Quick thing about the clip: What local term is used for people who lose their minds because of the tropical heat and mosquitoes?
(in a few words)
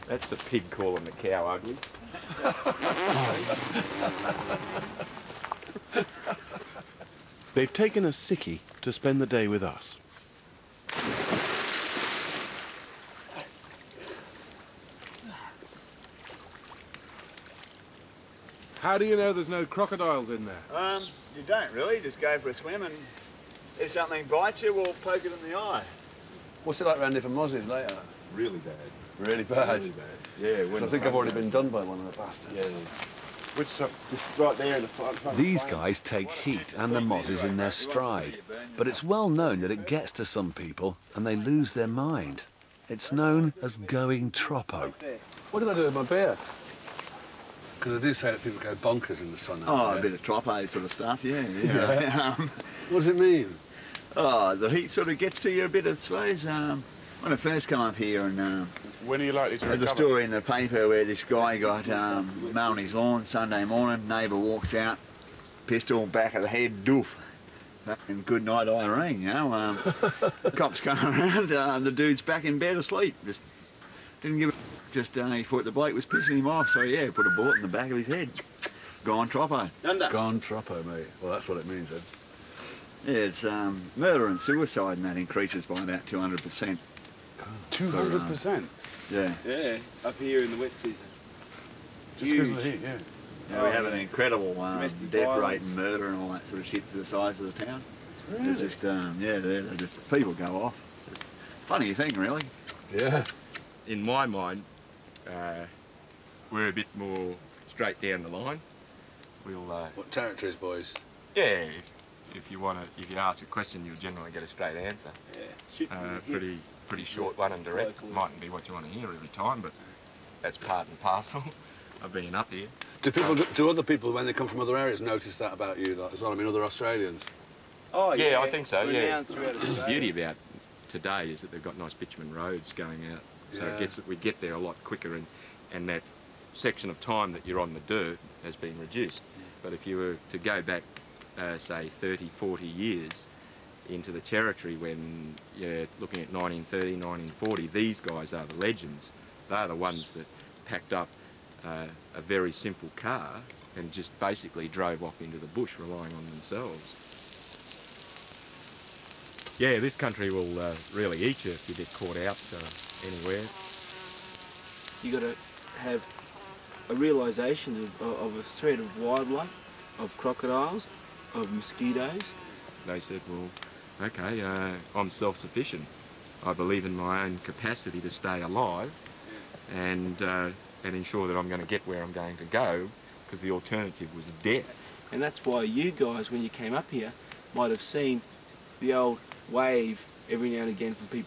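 Going troppo.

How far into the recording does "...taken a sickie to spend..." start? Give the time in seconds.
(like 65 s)
7 s.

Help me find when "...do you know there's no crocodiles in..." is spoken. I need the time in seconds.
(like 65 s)
18 s.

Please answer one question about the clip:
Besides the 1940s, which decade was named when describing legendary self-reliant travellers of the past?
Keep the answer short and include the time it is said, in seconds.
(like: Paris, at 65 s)
1930, at 146 s.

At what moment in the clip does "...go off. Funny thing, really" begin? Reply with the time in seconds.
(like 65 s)
100 s.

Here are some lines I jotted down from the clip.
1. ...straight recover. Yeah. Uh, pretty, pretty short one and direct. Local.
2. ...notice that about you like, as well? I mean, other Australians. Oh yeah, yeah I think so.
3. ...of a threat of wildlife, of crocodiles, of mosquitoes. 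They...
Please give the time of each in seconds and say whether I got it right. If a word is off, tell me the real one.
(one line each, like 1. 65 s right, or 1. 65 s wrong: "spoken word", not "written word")
1. 114 s wrong: "answer", not "recover"
2. 124 s right
3. 168 s right.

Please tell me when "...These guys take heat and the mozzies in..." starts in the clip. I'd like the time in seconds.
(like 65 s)
35 s.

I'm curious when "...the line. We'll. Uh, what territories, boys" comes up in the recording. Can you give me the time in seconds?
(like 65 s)
108 s.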